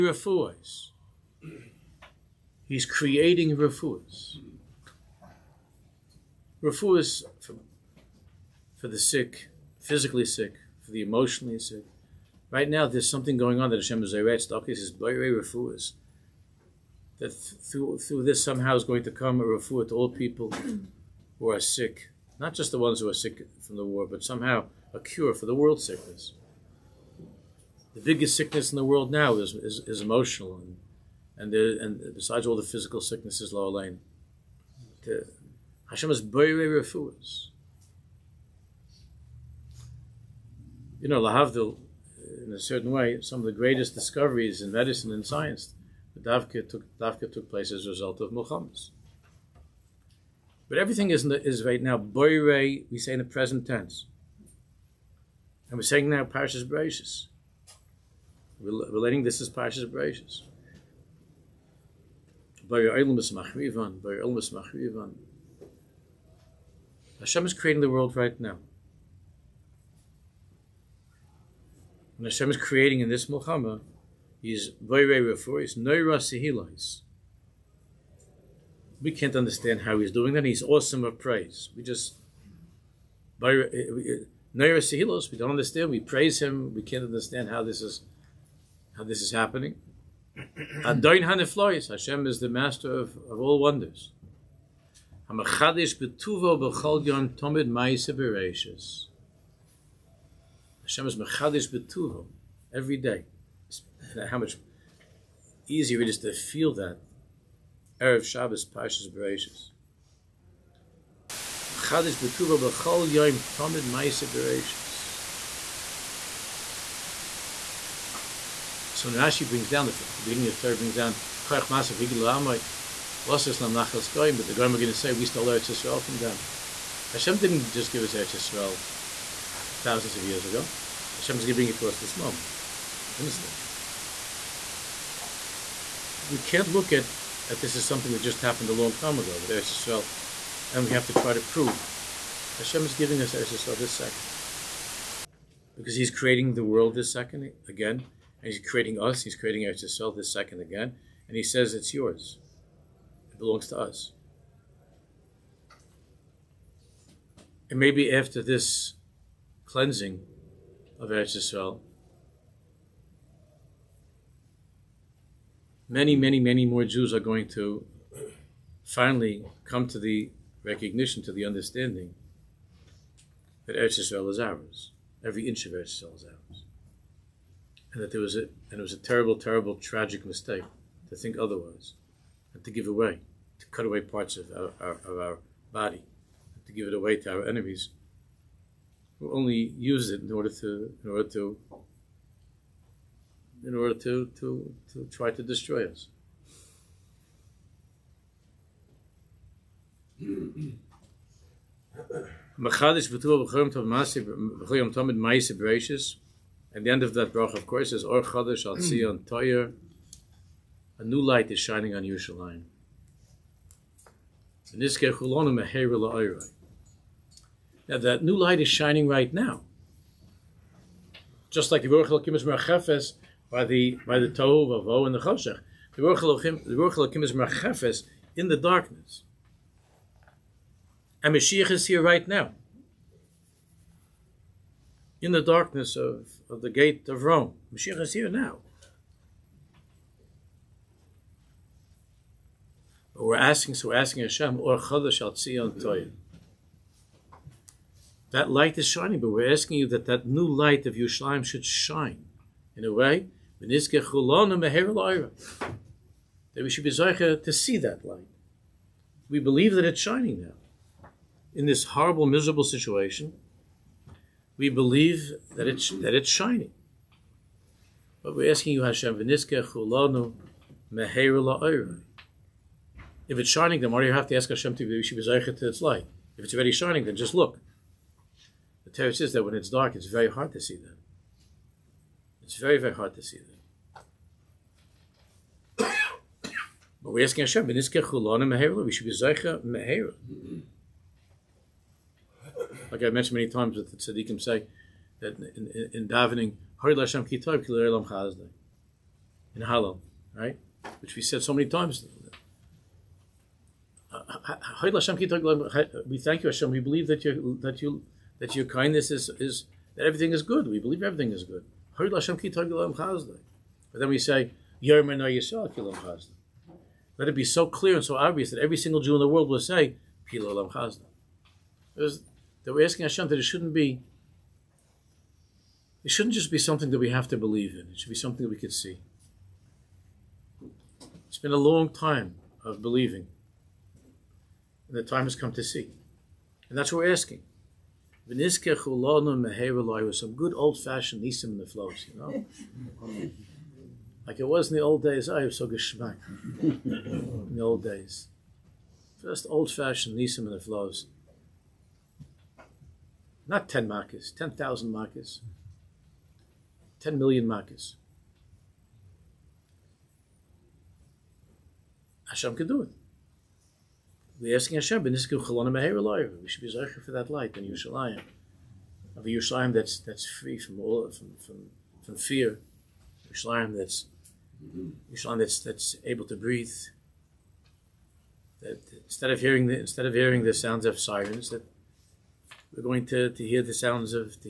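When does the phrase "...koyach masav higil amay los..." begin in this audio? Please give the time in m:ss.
2:01.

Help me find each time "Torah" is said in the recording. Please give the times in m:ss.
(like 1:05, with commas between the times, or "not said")
2:00, 4:38.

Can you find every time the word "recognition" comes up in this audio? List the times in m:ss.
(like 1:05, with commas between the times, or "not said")
2:50.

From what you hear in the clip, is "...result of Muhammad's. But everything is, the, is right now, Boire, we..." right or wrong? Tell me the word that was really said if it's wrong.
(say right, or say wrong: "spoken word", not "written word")
right.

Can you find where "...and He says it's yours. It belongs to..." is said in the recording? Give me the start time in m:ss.
2:31.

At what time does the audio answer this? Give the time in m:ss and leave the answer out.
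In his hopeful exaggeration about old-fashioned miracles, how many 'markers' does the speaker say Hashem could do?
5:57.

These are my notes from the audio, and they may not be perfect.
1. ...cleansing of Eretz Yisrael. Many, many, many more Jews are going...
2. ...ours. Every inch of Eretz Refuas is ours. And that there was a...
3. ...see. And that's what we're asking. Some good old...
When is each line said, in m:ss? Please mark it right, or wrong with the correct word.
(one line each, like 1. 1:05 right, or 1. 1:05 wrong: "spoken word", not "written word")
1. 2:39 right
2. 2:54 wrong: "Yisrael", not "Refuas"
3. 5:35 right.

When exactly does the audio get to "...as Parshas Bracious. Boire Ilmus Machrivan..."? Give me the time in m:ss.
0:59.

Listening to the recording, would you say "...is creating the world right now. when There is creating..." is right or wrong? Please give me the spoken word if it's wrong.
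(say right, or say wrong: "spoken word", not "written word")
wrong: "Hashem", not "There".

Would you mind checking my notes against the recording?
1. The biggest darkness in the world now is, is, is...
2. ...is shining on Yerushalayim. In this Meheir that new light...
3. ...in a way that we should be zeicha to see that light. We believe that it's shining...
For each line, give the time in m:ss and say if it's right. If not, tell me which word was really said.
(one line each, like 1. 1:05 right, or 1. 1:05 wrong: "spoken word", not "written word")
1. 0:27 wrong: "sickness", not "darkness"
2. 3:31 right
3. 4:12 right.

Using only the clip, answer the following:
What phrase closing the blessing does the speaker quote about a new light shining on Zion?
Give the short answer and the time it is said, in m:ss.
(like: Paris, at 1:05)
Or Chadash Al Tzion, at 3:28.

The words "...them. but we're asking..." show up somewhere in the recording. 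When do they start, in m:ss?
4:45.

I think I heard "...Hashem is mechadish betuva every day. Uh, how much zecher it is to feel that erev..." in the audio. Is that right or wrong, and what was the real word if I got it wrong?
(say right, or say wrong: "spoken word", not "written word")
wrong: "easier", not "zecher".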